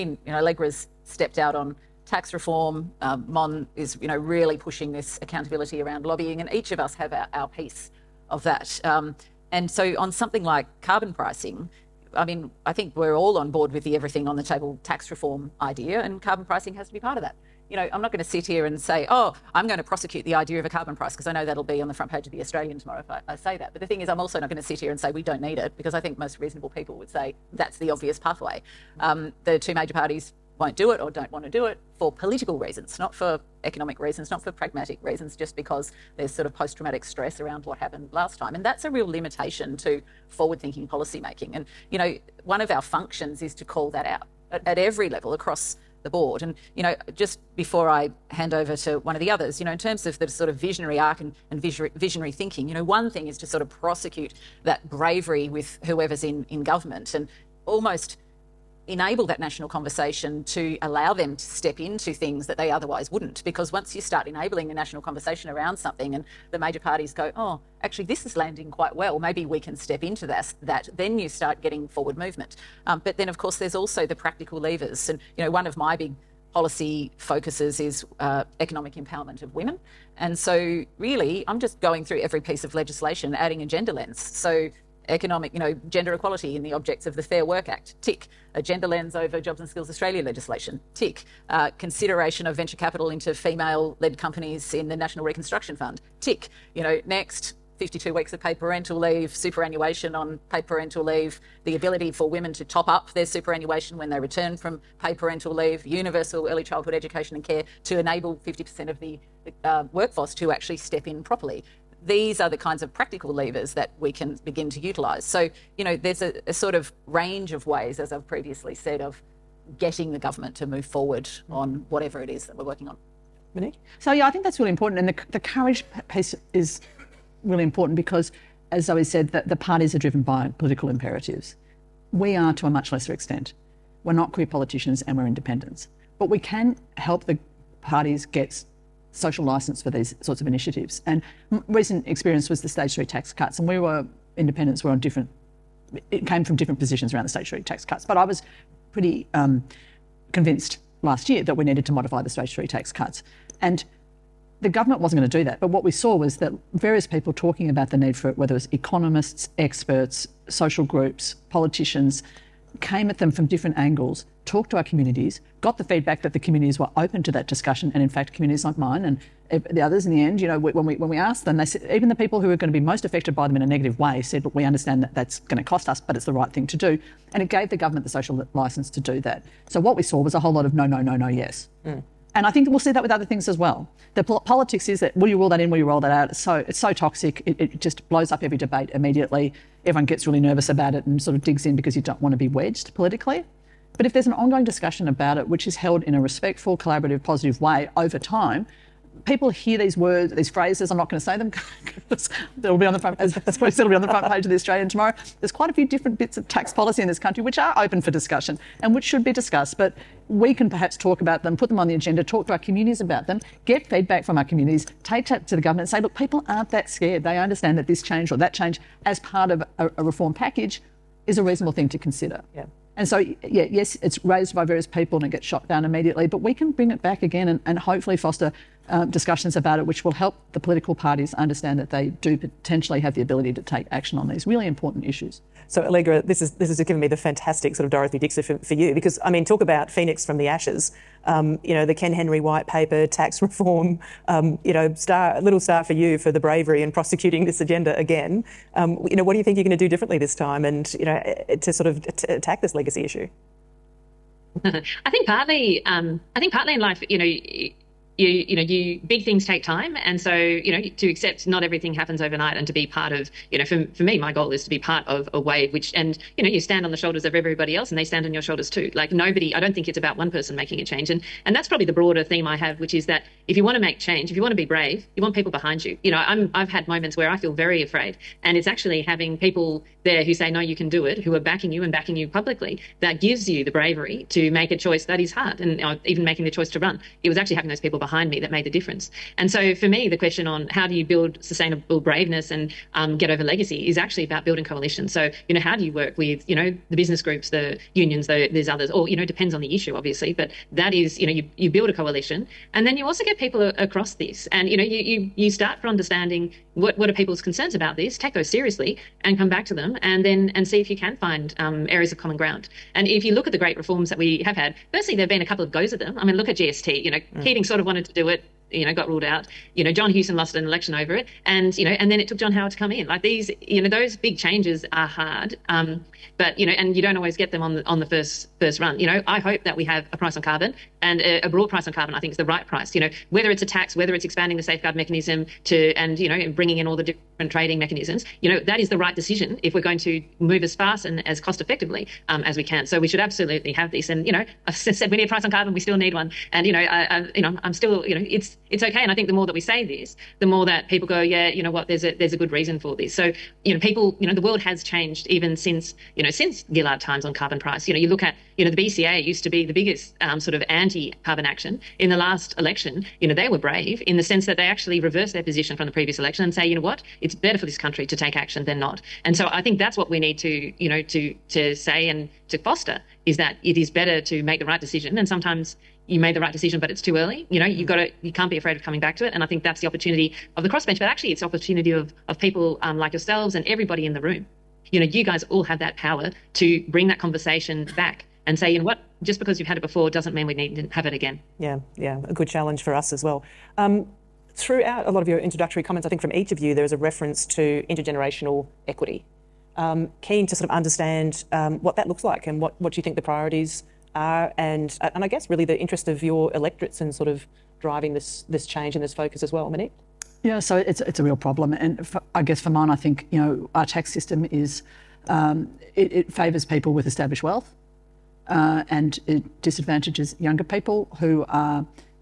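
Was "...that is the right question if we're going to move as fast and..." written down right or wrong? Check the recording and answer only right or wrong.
wrong.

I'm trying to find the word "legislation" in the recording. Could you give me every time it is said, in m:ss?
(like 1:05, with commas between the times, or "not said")
1:22, 1:30.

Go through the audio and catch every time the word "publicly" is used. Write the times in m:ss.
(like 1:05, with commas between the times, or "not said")
4:42.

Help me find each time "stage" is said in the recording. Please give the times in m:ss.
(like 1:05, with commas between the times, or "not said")
2:22, 2:27, 2:32.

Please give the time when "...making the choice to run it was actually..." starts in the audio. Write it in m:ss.
4:46.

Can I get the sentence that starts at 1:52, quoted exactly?
These are the kinds of practical levers that we can begin to utilise.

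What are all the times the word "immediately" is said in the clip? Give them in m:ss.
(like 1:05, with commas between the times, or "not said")
3:08, 3:45.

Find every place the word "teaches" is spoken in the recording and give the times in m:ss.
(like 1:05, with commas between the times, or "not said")
not said.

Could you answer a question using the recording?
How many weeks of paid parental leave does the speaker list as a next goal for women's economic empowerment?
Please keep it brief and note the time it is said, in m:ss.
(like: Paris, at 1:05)
52, at 1:37.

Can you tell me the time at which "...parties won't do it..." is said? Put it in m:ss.
0:29.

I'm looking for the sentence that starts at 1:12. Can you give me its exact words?
Um, but then, of course, there's also the practical levers.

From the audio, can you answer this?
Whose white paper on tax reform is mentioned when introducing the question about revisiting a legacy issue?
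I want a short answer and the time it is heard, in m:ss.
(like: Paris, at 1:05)
Ken Henry, at 4:01.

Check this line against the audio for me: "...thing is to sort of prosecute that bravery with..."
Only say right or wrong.
right.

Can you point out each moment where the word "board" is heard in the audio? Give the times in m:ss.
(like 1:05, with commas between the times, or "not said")
0:13, 0:46.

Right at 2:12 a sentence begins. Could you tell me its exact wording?
We are to a much lesser extent.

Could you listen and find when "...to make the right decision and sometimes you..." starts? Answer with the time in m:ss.
6:14.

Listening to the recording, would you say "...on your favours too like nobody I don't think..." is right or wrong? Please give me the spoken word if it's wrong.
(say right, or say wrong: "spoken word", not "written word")
wrong: "shoulders", not "favours".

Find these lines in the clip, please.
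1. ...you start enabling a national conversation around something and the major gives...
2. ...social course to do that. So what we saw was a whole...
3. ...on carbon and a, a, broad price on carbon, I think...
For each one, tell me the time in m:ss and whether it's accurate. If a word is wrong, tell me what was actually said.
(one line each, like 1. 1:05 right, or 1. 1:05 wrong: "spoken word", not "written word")
1. 1:03 wrong: "parties", not "gives"
2. 2:58 wrong: "license", not "course"
3. 5:30 right.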